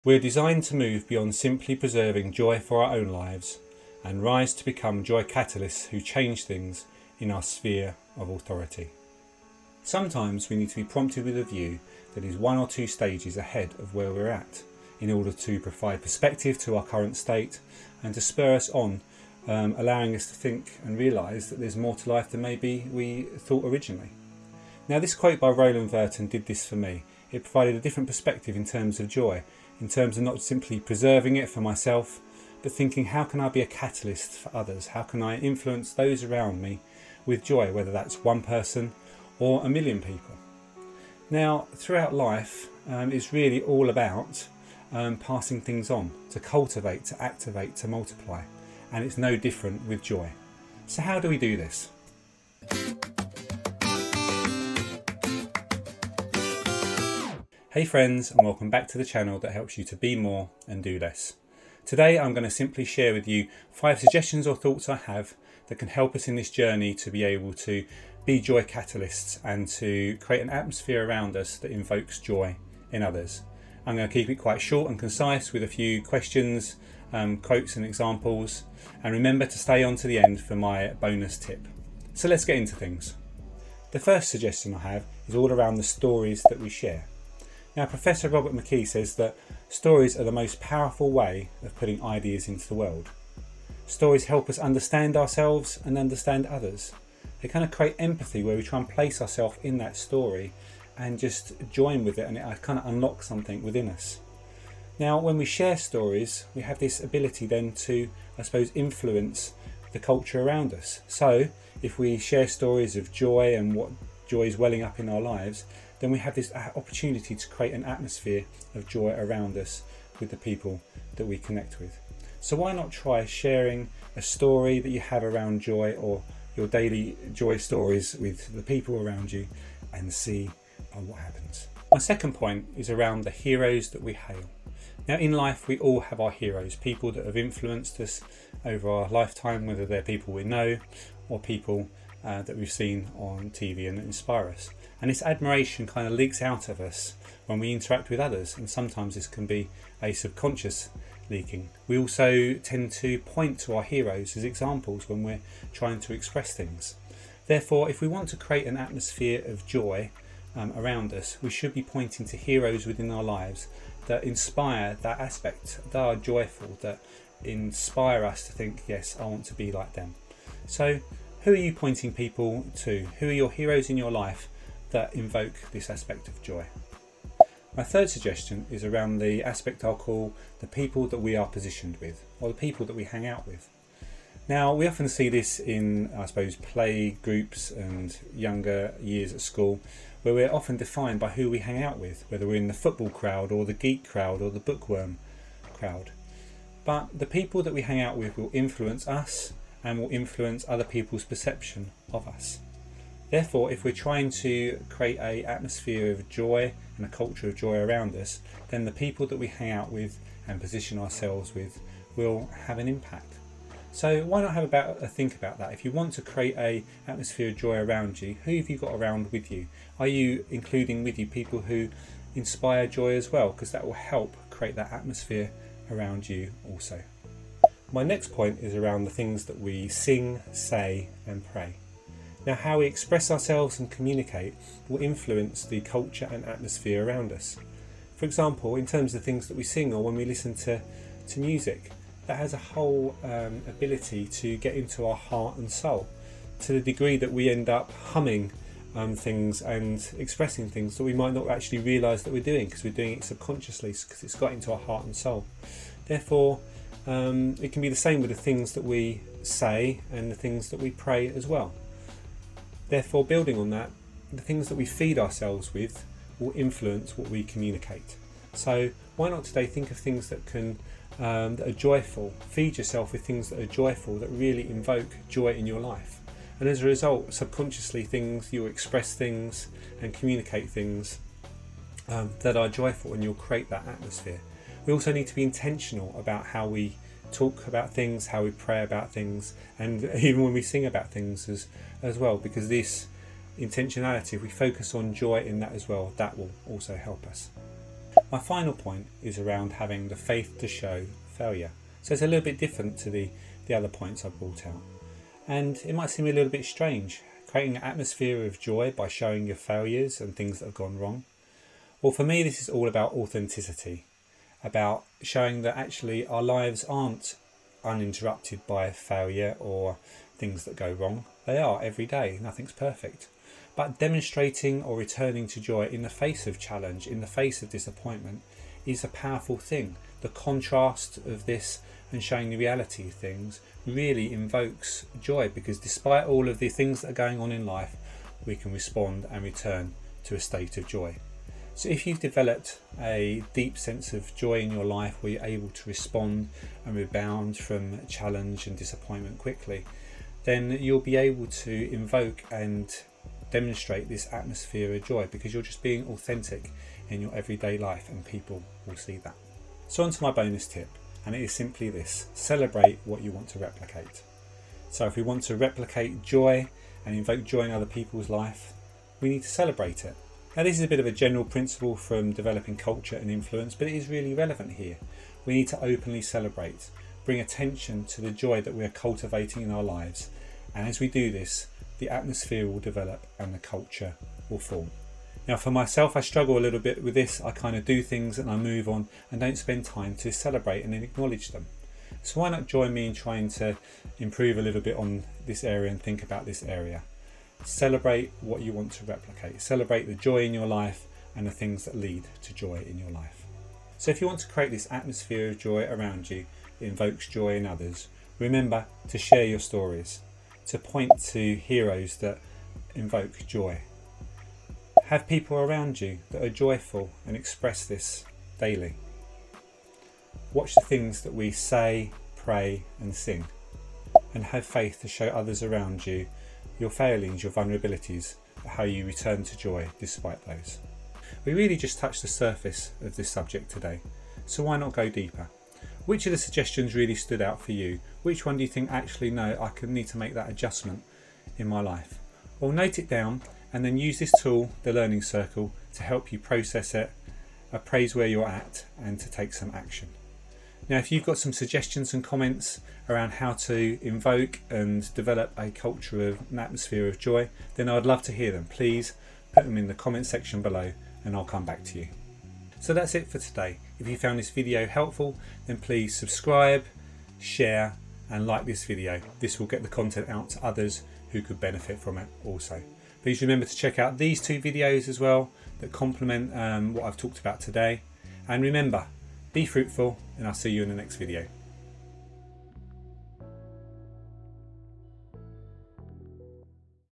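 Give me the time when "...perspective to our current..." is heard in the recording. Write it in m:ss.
0:16.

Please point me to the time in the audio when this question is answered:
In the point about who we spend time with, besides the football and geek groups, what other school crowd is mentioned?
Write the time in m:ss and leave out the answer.
3:14.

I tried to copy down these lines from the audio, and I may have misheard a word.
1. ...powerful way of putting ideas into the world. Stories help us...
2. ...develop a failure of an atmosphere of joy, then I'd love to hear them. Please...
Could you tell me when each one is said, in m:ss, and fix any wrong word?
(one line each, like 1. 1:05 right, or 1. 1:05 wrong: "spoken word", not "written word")
1. 1:30 right
2. 7:35 wrong: "culture", not "failure".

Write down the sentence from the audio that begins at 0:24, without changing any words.
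Now, this quote by Roland Worton did this for me.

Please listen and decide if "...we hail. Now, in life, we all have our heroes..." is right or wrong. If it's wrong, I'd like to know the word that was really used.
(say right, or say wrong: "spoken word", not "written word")
right.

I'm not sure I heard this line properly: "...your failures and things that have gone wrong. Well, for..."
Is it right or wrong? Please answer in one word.
right.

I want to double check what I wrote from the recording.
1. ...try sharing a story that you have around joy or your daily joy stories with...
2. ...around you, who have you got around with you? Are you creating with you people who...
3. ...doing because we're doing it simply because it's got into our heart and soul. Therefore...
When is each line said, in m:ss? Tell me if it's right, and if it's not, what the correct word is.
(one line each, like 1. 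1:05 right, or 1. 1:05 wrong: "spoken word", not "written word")
1. 2:02 right
2. 3:37 wrong: "including", not "creating"
3. 4:12 wrong: "subconsciously", not "simply".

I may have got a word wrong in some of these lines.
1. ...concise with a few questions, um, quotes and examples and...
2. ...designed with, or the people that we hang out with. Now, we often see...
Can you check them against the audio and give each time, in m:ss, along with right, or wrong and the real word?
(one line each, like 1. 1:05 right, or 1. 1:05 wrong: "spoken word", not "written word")
1. 1:14 right
2. 3:01 wrong: "positioned", not "designed".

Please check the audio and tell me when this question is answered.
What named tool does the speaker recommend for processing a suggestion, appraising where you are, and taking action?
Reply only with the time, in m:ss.
7:24.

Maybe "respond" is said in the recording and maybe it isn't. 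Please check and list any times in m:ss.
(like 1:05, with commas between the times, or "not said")
5:38, 5:45.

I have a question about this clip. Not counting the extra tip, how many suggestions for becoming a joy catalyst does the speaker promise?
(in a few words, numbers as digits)
5.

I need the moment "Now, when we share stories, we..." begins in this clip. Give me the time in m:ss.
1:44.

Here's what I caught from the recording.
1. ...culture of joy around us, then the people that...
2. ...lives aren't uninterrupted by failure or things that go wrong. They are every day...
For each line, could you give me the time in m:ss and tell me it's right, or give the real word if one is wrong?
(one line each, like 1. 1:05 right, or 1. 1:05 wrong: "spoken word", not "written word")
1. 3:27 right
2. 5:16 right.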